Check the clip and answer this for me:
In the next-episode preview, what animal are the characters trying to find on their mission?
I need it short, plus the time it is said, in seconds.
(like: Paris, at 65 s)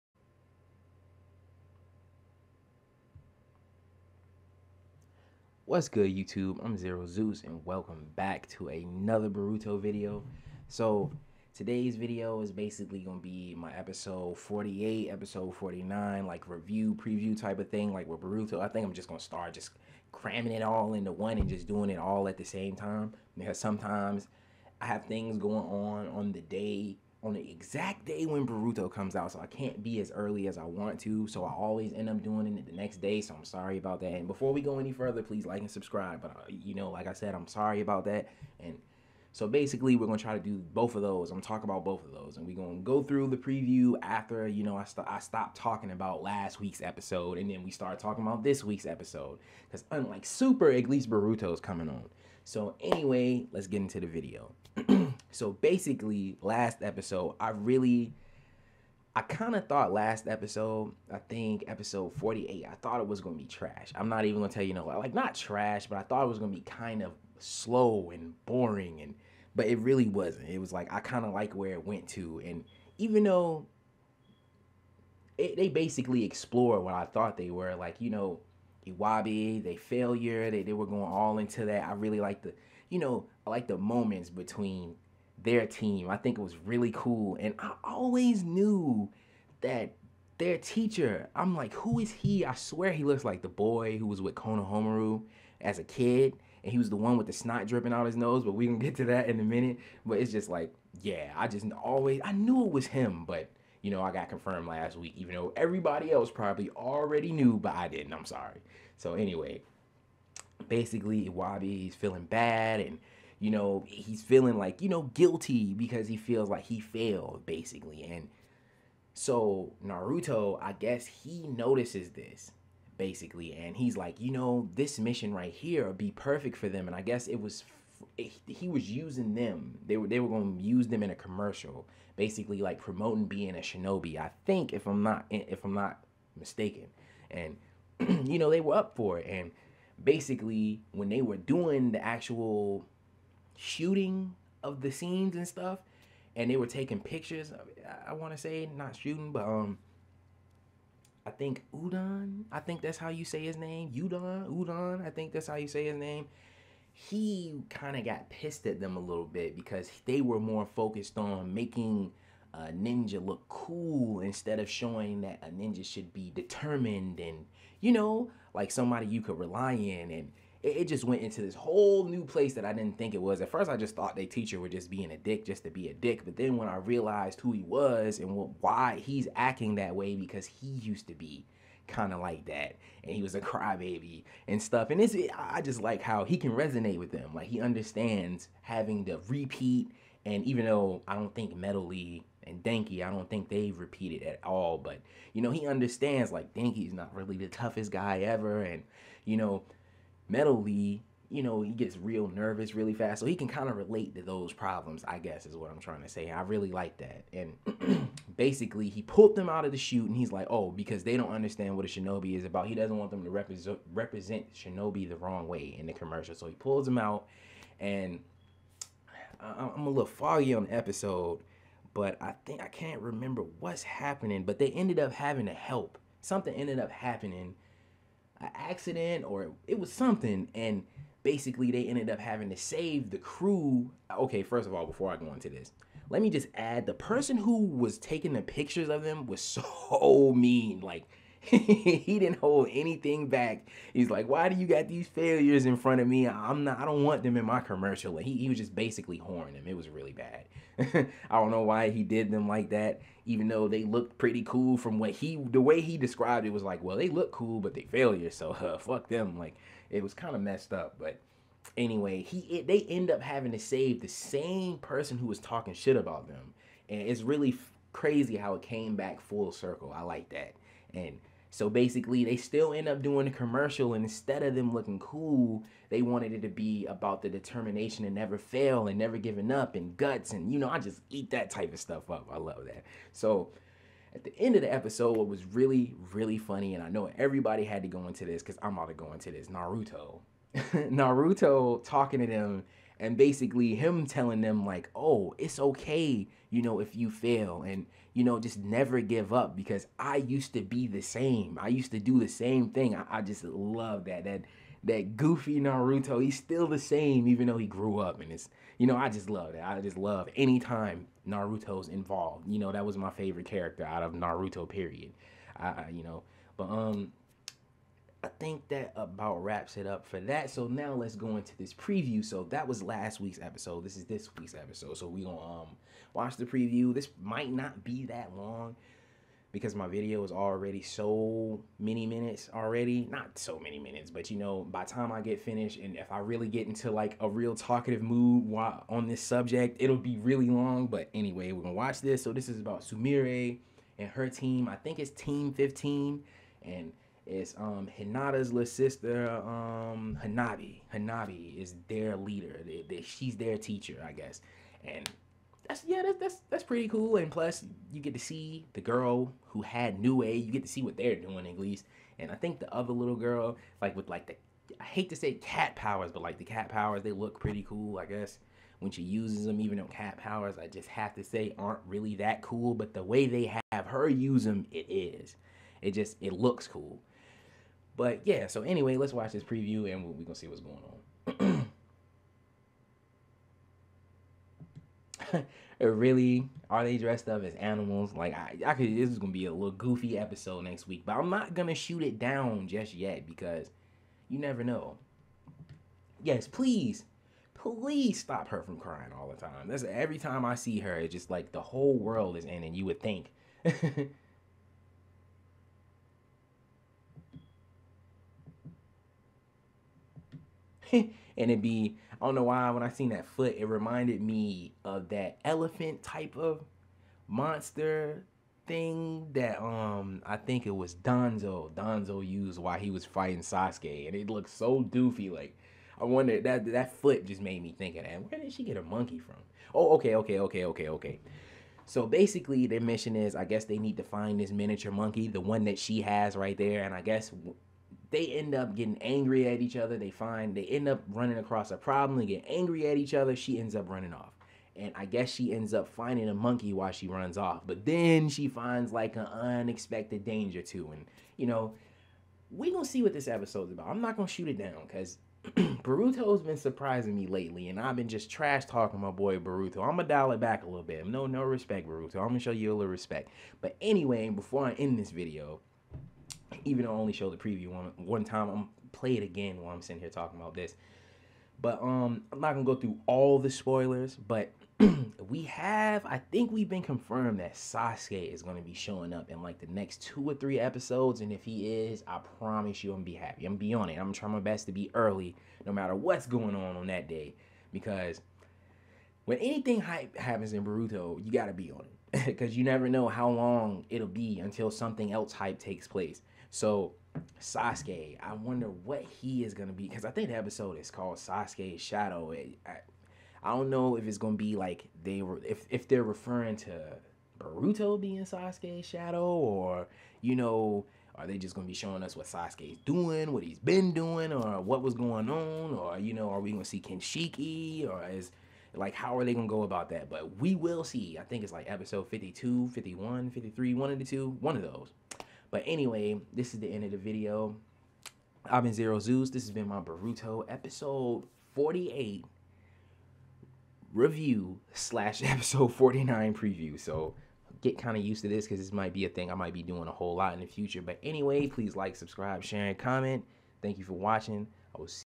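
miniature monkey, at 434 s.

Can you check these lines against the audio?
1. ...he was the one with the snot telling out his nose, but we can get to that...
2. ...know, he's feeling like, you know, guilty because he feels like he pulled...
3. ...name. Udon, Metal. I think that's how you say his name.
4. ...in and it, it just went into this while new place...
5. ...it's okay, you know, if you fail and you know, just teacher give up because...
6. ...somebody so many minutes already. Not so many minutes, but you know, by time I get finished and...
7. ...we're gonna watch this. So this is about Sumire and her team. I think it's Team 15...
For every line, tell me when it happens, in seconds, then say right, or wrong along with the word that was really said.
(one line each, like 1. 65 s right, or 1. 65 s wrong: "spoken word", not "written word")
1. 96 s wrong: "dripping", not "telling"
2. 113 s wrong: "failed", not "pulled"
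3. 153 s wrong: "Udon", not "Metal"
4. 169 s wrong: "whole", not "while"
5. 295 s wrong: "never", not "teacher"
6. 330 s wrong: "already", not "somebody"
7. 341 s right.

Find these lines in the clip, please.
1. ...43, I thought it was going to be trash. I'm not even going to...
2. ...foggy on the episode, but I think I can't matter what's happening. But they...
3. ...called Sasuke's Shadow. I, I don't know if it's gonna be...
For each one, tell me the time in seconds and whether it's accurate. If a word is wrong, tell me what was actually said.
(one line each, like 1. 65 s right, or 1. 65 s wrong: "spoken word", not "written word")
1. 62 s wrong: "48", not "43"
2. 220 s wrong: "remember", not "matter"
3. 500 s right.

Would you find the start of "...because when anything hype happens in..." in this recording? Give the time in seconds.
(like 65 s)
487 s.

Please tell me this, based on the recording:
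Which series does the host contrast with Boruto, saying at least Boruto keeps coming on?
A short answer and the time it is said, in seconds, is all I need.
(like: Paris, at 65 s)
Super, at 50 s.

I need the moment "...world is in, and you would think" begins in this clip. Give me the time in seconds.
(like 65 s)
401 s.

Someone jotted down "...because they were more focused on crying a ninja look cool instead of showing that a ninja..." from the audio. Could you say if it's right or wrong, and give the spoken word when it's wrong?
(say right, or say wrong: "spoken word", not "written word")
wrong: "making", not "crying".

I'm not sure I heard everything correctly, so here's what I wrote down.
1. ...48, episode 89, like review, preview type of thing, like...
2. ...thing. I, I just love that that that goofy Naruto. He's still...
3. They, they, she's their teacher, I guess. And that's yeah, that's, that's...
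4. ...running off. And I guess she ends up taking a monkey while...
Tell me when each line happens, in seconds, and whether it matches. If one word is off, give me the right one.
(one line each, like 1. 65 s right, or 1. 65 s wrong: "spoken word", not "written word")
1. 14 s wrong: "49", not "89"
2. 302 s right
3. 352 s right
4. 443 s wrong: "finding", not "taking".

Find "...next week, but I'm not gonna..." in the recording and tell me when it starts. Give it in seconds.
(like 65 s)
390 s.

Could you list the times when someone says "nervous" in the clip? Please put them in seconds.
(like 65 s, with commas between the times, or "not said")
202 s.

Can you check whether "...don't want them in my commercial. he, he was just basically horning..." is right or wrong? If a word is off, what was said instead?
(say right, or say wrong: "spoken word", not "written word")
right.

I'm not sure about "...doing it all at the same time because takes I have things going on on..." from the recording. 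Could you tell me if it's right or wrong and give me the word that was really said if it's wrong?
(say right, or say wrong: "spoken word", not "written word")
wrong: "sometimes", not "takes".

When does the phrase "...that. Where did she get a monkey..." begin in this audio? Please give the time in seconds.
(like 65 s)
428 s.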